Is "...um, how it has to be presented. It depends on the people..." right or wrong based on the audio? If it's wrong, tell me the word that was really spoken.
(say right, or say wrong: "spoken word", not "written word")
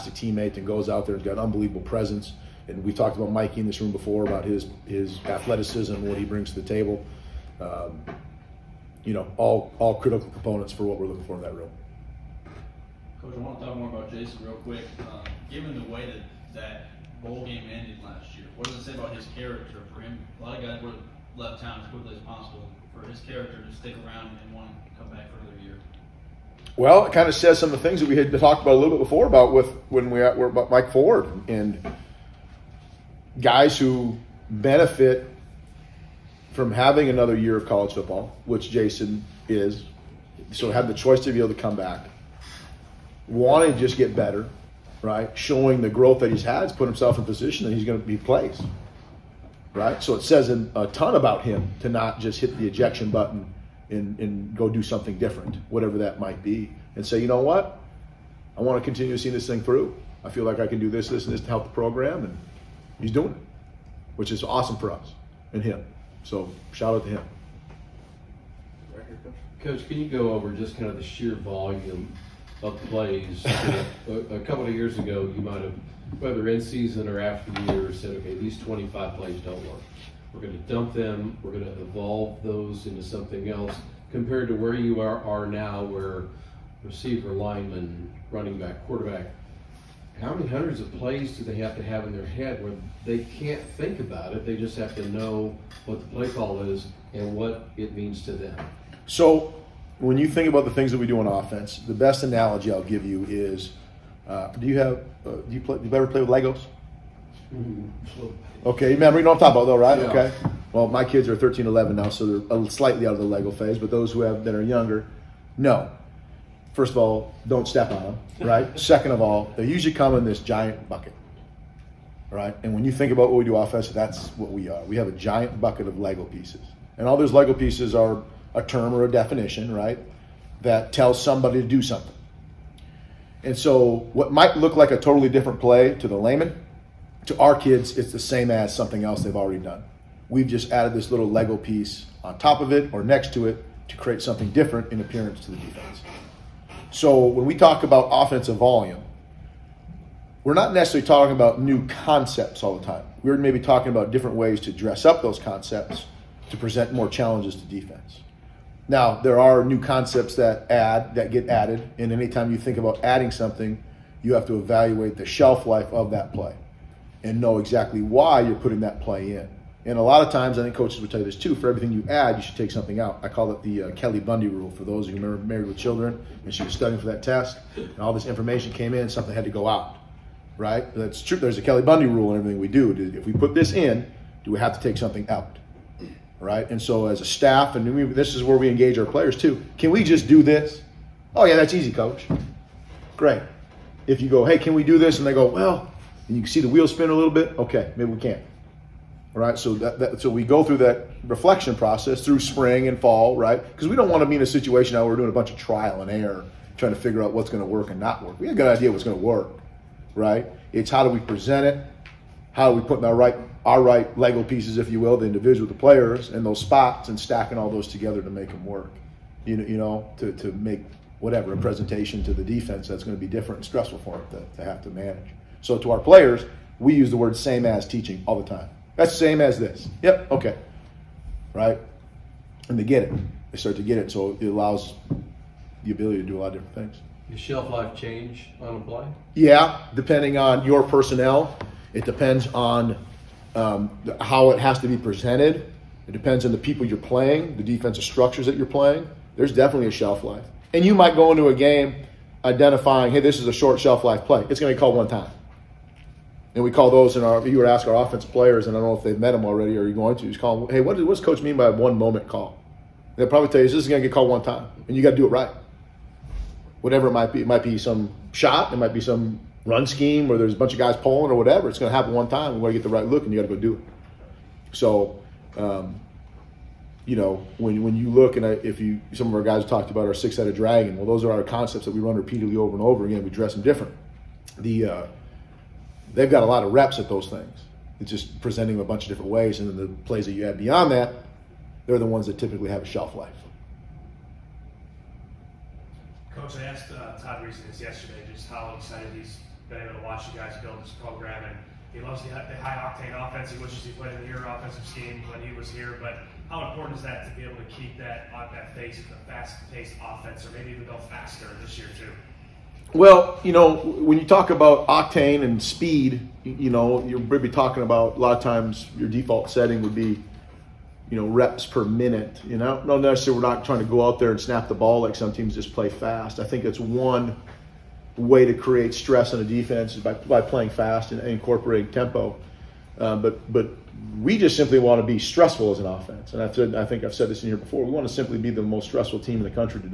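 right.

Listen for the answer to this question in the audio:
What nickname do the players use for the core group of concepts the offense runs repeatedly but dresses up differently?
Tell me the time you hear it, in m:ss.
4:40.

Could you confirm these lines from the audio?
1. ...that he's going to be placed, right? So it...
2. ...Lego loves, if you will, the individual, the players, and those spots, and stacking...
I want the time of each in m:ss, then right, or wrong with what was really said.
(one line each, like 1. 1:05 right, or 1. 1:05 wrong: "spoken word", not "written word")
1. 0:47 right
2. 3:34 wrong: "pieces", not "loves".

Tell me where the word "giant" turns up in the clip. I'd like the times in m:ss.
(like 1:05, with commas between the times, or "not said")
2:00, 2:05.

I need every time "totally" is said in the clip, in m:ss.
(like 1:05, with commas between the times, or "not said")
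2:14.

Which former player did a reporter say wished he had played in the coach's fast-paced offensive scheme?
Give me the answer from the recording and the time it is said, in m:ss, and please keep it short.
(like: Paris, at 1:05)
Todd Reesing, at 4:57.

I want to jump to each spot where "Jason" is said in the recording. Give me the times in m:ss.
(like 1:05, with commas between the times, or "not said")
0:14, 0:38.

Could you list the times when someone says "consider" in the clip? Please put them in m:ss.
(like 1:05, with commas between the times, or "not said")
not said.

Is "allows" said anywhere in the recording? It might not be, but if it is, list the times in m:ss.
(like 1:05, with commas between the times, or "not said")
3:54.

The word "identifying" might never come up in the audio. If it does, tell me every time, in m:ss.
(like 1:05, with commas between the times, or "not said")
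4:12.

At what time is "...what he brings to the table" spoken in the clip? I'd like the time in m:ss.
0:06.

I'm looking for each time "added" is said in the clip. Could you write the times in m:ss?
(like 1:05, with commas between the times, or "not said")
2:20, 2:41.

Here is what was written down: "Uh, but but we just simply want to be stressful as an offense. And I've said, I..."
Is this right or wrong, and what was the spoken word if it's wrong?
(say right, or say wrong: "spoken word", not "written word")
right.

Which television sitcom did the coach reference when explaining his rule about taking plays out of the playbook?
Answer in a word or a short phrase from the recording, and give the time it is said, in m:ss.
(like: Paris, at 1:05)
Married with Children, at 2:55.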